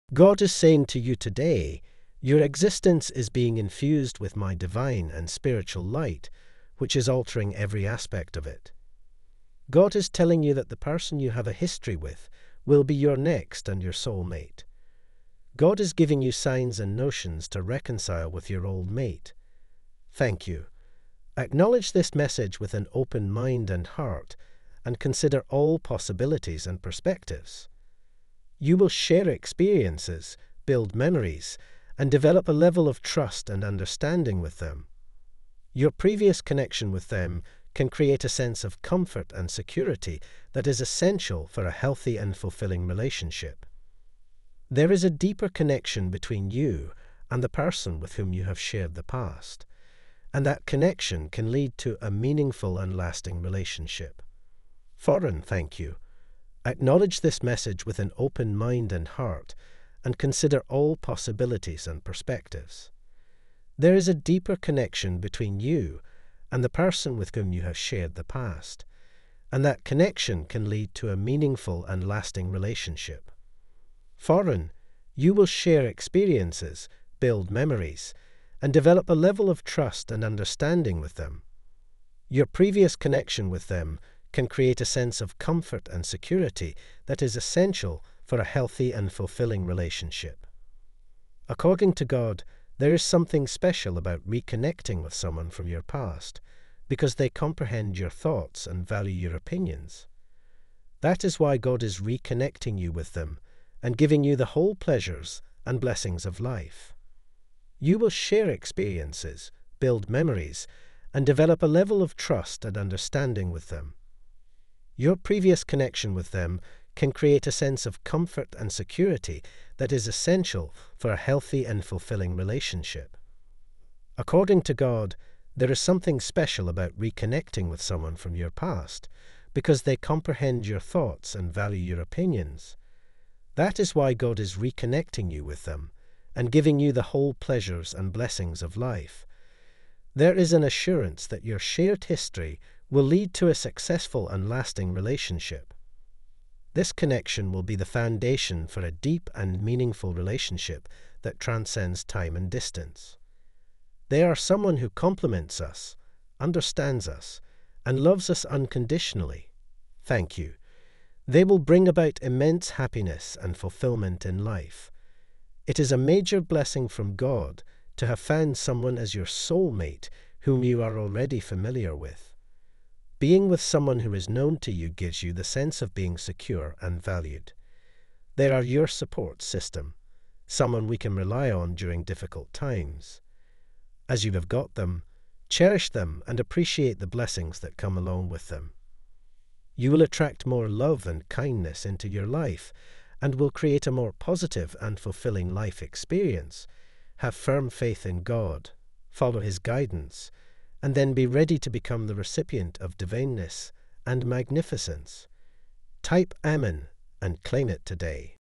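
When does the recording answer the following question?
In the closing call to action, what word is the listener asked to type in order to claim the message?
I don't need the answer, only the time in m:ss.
3:26.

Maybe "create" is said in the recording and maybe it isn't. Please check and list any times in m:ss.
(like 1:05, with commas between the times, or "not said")
0:37, 1:24, 1:57, 3:13.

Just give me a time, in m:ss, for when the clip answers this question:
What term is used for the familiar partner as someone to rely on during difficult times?
2:58.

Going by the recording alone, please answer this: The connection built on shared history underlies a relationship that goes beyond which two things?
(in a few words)
time and distance.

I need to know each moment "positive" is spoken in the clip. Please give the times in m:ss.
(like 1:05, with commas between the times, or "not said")
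3:14.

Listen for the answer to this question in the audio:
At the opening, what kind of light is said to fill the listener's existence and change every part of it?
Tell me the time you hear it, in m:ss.
0:04.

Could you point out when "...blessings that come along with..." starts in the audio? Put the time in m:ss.
3:07.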